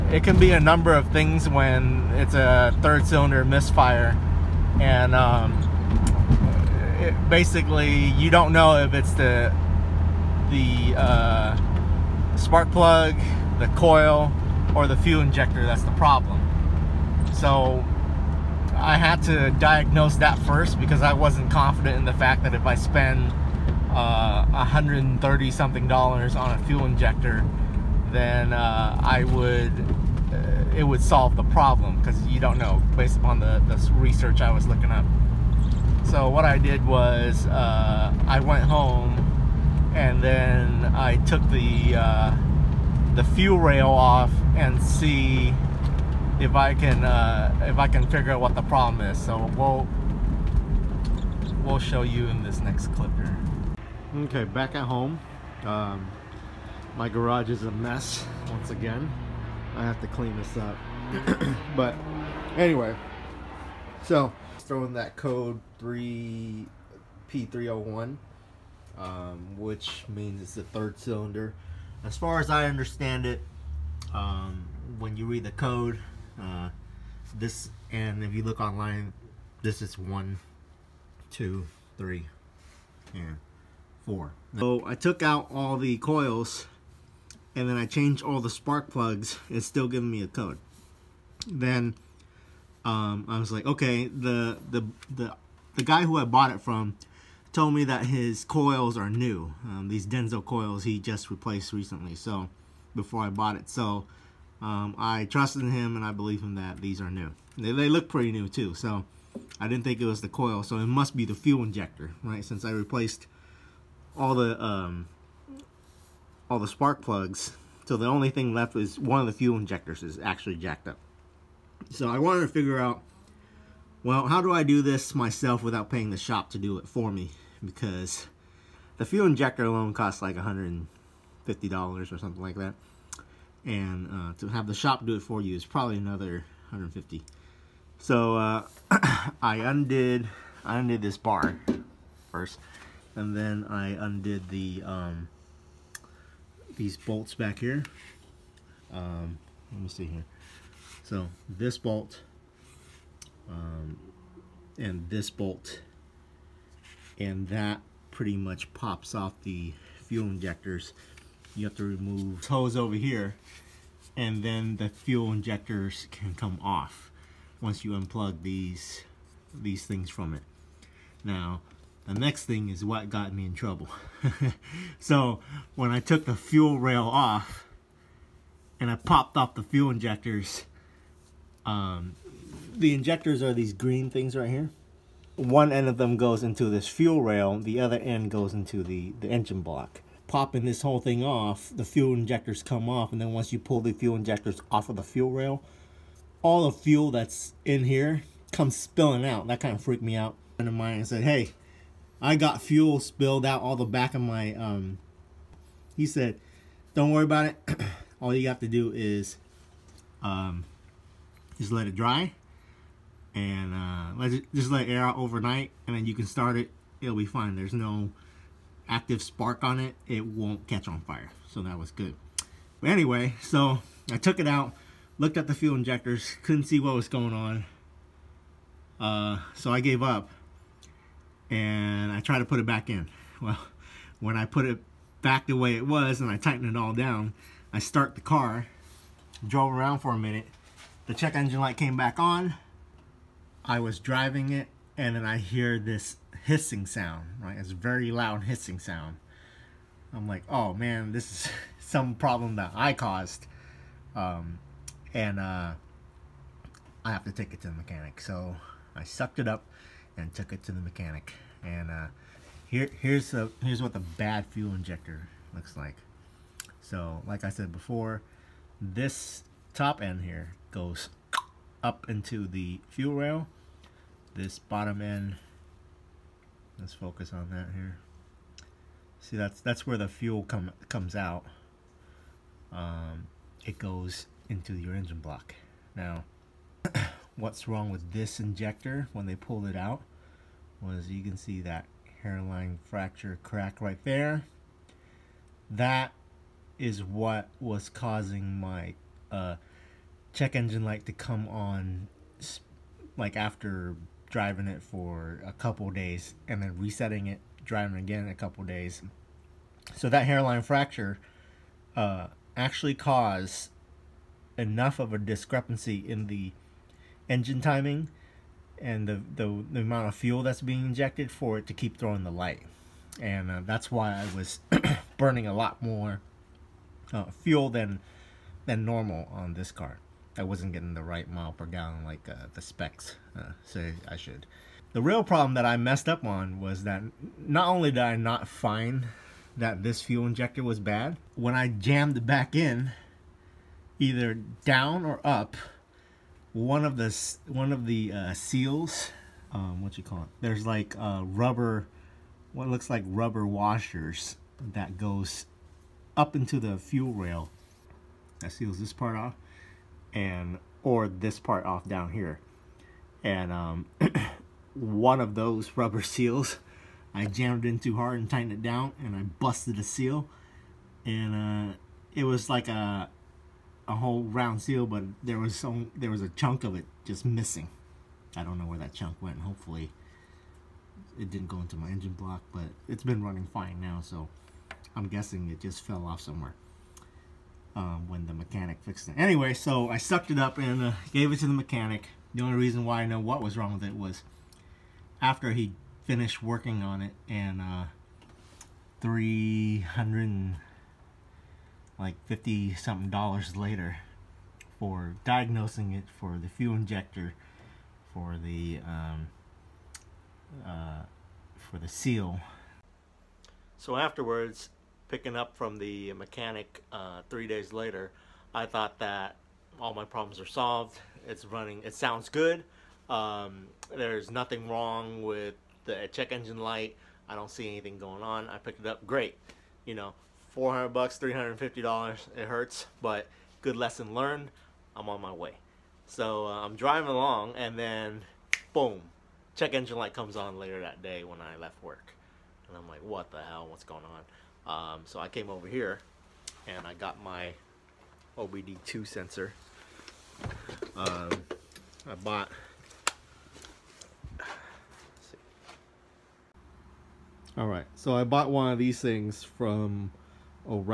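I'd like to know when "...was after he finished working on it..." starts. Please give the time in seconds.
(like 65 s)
393 s.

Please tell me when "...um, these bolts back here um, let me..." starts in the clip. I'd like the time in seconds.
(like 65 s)
144 s.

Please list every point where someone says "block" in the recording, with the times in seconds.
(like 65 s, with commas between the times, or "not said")
189 s, 285 s, 382 s.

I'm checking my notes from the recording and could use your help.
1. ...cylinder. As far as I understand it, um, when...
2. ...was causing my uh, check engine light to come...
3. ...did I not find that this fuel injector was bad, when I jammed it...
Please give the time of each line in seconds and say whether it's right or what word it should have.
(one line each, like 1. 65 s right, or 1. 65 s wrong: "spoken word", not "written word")
1. 70 s right
2. 297 s right
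3. 337 s right.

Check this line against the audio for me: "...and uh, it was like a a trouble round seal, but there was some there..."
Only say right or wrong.
wrong.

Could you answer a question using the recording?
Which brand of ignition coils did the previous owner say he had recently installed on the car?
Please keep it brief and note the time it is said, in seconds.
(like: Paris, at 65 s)
Denso, at 100 s.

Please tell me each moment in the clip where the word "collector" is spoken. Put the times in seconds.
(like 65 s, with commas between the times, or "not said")
not said.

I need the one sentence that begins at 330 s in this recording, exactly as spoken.
I wasn't getting the right mile per gallon like uh, the specs uh, say I should.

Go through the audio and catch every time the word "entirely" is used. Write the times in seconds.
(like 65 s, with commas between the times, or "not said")
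not said.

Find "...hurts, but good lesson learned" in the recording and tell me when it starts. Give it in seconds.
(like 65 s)
432 s.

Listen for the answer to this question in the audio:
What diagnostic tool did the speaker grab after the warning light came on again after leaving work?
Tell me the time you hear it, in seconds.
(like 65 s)
448 s.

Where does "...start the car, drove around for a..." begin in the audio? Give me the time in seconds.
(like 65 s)
237 s.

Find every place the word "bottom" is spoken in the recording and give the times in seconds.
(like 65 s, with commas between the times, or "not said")
274 s.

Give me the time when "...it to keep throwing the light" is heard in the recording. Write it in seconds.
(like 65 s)
321 s.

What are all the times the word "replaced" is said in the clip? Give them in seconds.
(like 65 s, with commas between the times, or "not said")
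101 s, 112 s.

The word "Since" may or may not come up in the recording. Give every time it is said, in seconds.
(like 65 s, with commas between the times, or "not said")
112 s.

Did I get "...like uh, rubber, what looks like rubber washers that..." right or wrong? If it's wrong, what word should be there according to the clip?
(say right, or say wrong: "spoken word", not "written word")
right.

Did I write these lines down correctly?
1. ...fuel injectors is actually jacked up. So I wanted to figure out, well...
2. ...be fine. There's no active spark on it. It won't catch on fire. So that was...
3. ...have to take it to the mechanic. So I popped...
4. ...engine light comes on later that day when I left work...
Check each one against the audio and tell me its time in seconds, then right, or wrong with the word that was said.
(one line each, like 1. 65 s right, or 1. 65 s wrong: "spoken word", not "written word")
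1. 119 s right
2. 217 s right
3. 257 s wrong: "sucked", not "popped"
4. 439 s right.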